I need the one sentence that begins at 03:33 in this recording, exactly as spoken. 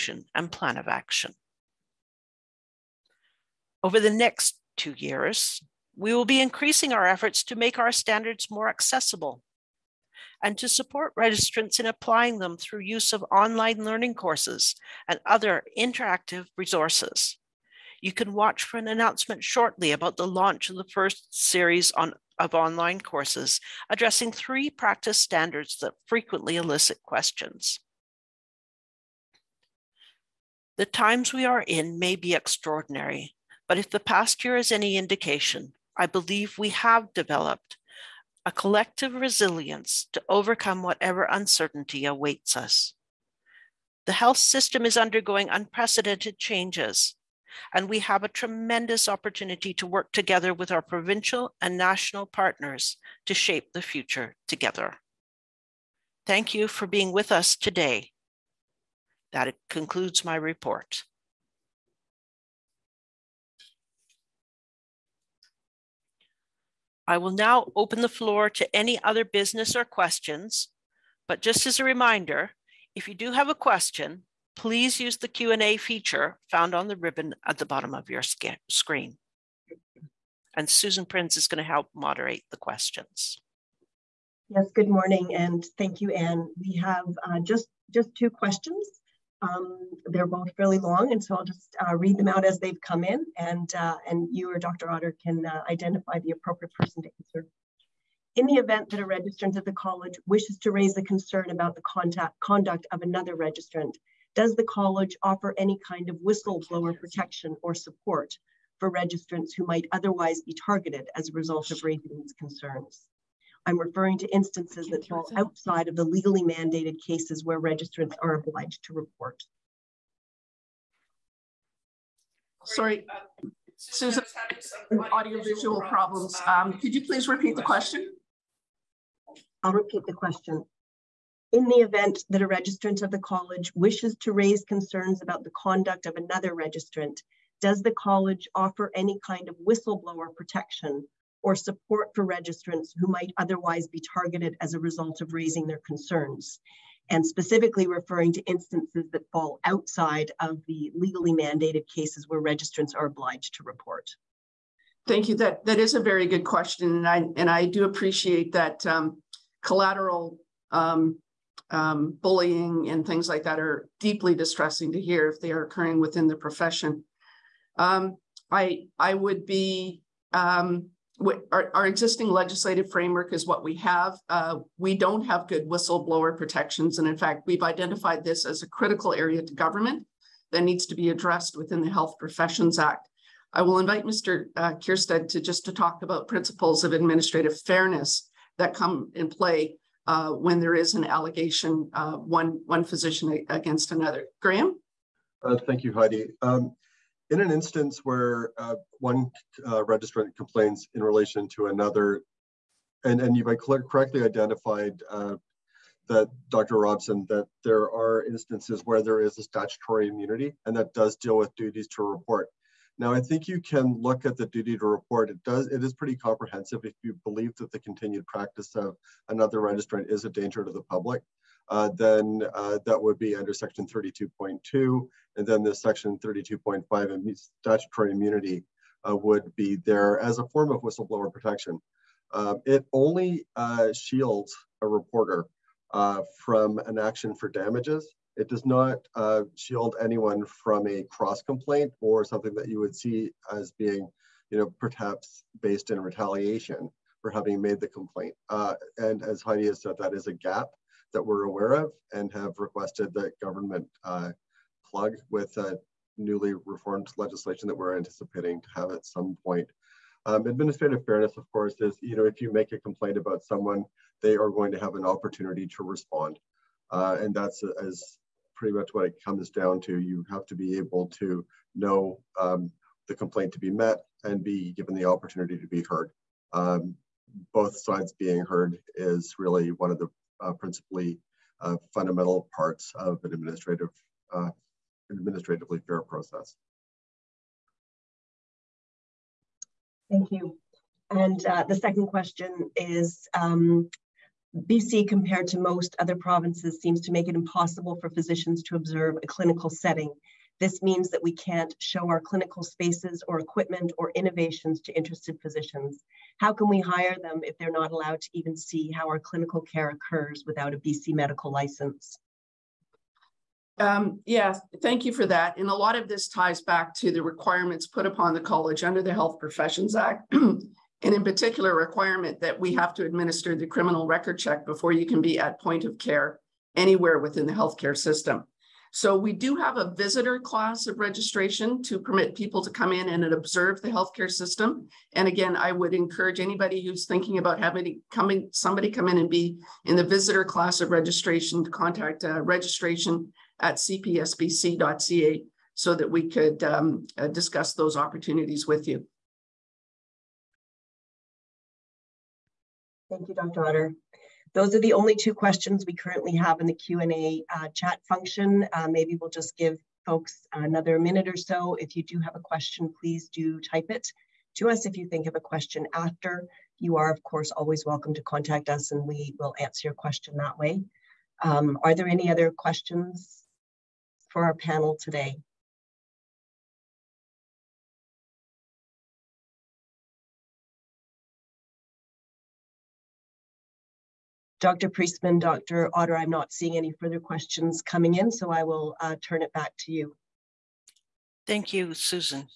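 Now, I think you can look at the duty to report.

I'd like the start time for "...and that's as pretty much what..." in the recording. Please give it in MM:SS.
04:27.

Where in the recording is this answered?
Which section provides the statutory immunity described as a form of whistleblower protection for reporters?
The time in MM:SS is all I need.
03:45.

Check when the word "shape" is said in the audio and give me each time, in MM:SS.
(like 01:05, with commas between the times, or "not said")
00:53.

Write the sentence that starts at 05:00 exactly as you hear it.
This means that we can't show our clinical spaces or equipment or innovations to interested physicians.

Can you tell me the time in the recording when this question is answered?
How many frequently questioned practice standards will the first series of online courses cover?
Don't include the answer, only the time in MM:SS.
00:24.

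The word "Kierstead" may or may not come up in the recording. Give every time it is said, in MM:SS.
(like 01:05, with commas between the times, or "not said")
03:04.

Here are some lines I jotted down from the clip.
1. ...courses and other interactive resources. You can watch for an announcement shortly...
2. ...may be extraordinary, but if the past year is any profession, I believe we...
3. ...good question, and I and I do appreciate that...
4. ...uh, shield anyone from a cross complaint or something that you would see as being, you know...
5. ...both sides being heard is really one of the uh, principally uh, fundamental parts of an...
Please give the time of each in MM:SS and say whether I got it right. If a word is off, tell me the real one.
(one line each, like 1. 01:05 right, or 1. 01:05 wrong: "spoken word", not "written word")
1. 00:14 right
2. 00:31 wrong: "indication", not "profession"
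3. 02:36 right
4. 03:59 right
5. 04:37 right.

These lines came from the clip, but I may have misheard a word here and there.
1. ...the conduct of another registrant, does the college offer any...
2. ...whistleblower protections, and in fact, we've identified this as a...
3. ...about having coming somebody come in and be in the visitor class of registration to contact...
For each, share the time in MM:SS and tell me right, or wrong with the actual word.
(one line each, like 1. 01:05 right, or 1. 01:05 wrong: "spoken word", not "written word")
1. 02:15 right
2. 02:55 right
3. 05:37 right.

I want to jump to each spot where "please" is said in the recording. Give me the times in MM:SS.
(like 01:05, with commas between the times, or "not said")
01:14, 02:07, 06:03.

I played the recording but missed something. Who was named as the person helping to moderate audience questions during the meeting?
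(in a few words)
Susan Prinz.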